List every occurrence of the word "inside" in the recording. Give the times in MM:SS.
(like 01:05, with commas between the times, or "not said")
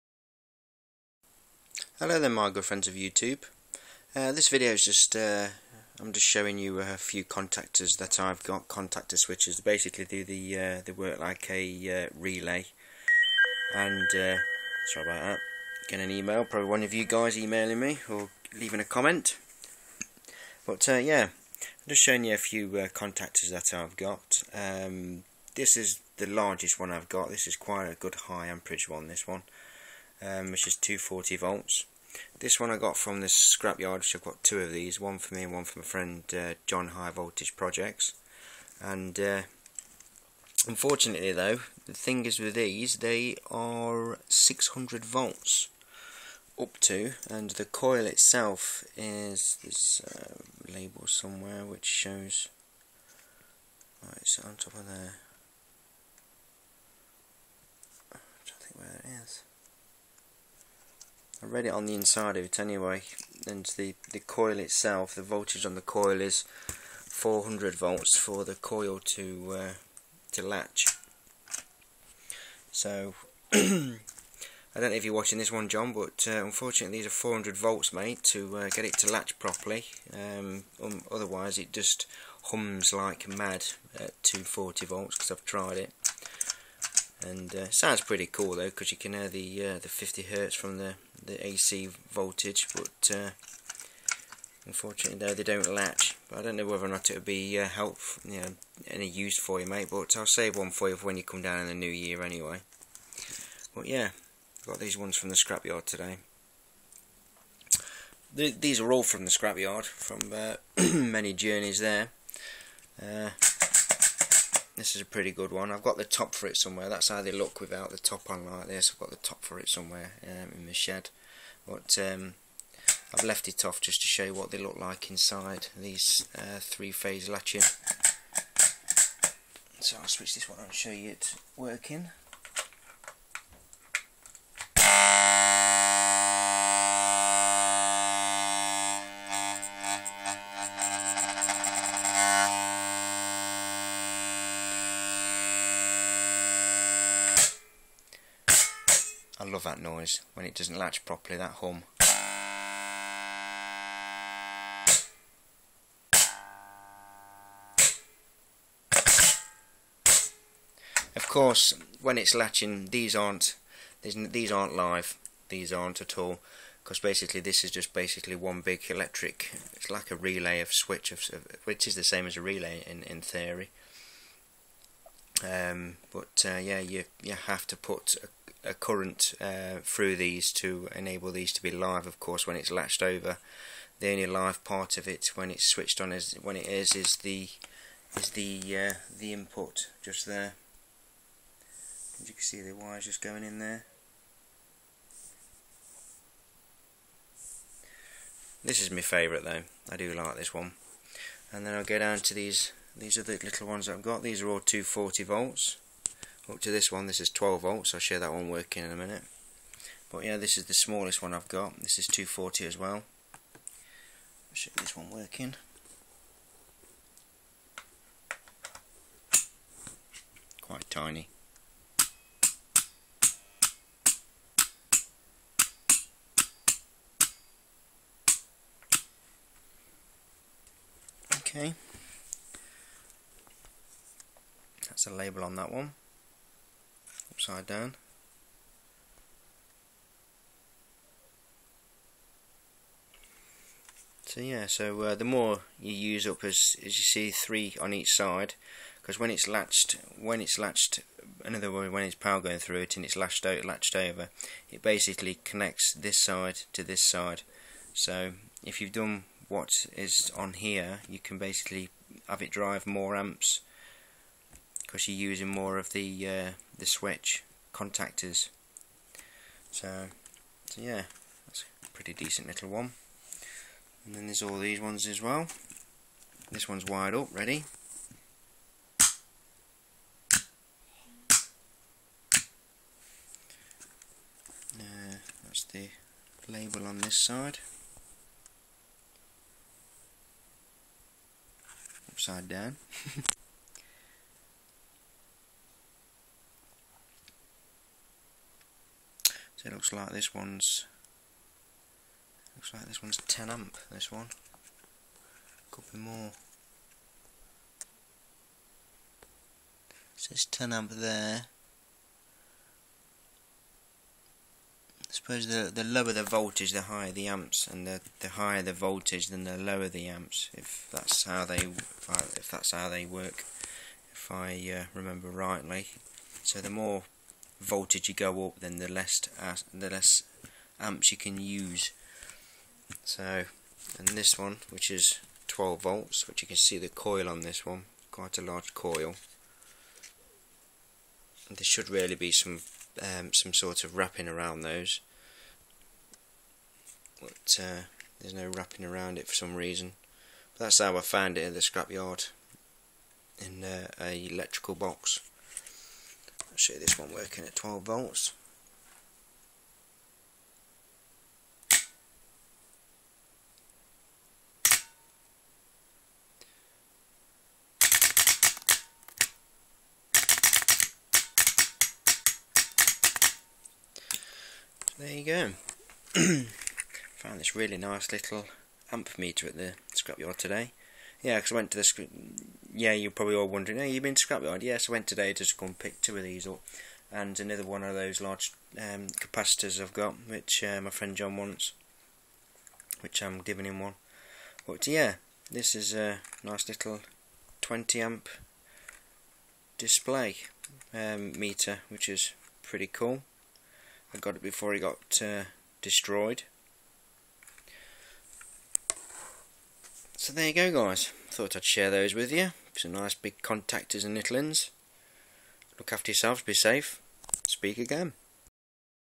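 01:01, 02:05.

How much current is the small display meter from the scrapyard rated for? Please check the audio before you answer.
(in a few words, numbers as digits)
20 amps.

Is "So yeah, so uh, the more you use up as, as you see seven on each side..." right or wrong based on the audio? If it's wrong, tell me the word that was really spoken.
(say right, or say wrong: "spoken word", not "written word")
wrong: "three", not "seven".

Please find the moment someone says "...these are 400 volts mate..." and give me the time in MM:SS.
01:16.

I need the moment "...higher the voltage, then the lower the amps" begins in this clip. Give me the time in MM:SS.
05:18.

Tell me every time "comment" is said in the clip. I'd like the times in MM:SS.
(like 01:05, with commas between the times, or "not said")
00:18.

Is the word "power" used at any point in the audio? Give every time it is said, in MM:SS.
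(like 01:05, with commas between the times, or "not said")
04:12.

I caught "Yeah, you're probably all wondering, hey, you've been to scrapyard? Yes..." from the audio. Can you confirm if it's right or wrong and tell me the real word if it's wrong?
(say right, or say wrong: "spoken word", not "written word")
right.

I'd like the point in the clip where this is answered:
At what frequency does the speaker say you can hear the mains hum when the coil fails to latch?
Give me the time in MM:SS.
01:29.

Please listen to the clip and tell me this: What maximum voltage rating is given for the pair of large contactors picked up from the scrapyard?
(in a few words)
600 volts.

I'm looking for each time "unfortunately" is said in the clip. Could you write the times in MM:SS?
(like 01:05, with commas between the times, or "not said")
00:40, 01:16, 01:34.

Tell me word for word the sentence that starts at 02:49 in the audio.
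It's like a relay of switch of, which is the same as a relay in in theory.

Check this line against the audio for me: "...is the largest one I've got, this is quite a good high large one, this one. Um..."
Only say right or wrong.
wrong.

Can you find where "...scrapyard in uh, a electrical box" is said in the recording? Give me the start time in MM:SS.
05:51.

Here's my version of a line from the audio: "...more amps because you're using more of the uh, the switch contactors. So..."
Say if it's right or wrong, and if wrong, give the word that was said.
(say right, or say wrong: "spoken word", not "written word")
right.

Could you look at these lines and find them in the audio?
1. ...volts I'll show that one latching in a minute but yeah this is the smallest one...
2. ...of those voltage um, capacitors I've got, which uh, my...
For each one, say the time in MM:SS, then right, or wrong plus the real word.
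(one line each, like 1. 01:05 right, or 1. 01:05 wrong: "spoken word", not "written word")
1. 03:27 wrong: "working", not "latching"
2. 06:27 wrong: "large", not "voltage".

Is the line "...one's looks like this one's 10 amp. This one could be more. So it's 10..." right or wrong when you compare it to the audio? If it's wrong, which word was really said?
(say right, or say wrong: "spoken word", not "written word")
right.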